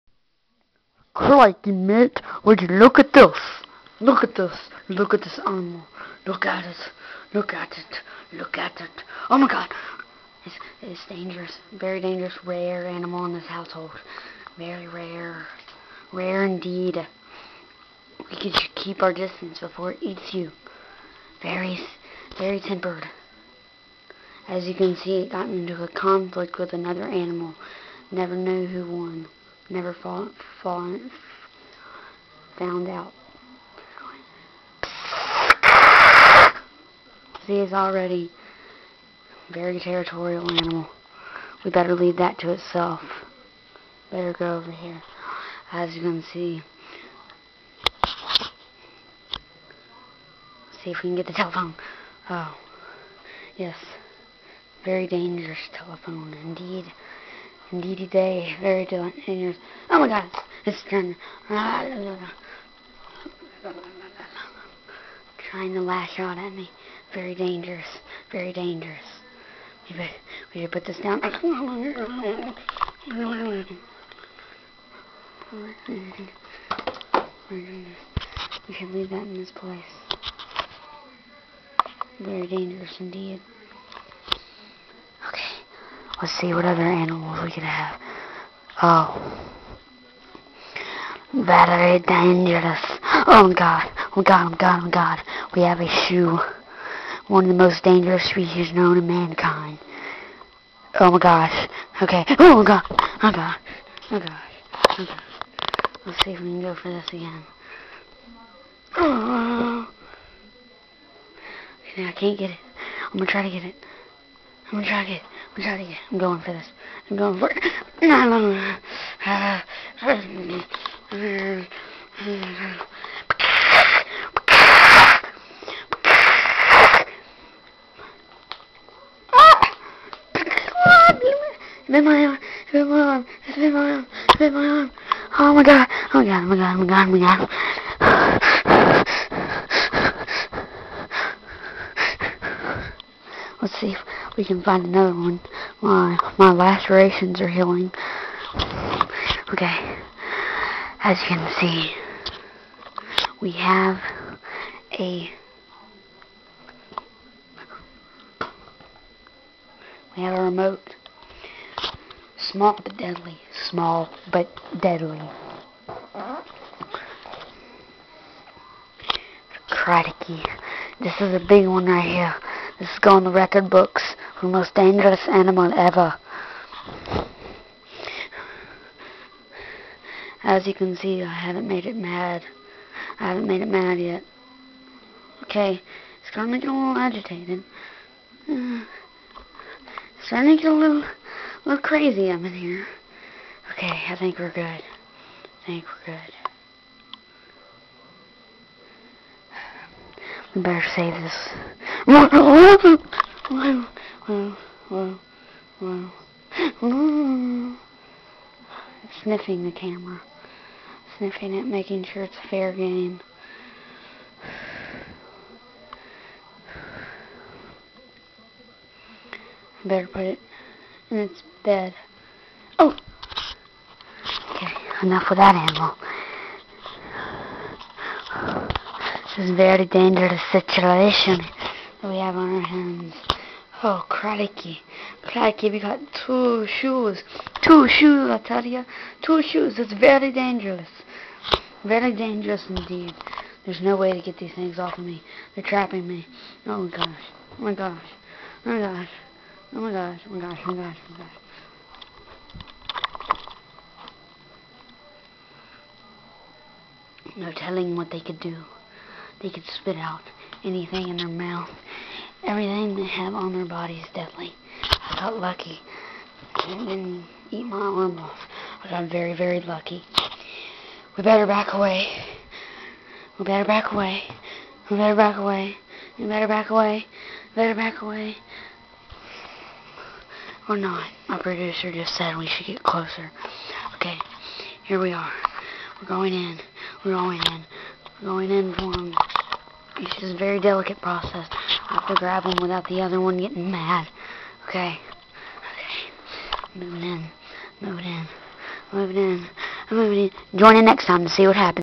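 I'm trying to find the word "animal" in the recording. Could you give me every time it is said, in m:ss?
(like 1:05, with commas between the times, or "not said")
0:05, 0:12, 0:27, 0:40, 1:26, 2:55, 3:45.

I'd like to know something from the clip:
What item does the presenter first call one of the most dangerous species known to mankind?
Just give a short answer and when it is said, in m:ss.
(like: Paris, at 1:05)
a shoe, at 1:35.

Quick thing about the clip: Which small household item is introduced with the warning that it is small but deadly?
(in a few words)
remote.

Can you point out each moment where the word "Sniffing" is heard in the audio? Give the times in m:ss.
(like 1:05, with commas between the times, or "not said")
3:22, 3:31.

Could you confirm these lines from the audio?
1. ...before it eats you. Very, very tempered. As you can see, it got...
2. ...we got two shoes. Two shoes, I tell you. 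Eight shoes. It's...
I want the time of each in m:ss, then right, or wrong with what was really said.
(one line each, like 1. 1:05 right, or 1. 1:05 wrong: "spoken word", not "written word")
1. 0:19 right
2. 3:55 wrong: "Two", not "Eight".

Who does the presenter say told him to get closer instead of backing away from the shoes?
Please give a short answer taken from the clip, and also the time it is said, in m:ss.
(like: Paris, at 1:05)
My producer, at 4:41.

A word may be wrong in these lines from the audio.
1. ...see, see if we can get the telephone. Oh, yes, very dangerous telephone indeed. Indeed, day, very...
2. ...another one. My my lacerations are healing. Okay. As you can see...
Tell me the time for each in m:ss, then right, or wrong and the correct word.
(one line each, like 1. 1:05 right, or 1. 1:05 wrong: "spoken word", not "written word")
1. 0:46 right
2. 2:24 right.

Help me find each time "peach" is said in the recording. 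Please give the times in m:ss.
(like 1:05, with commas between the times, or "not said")
not said.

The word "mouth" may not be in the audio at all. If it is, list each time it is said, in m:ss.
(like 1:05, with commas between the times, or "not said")
4:21.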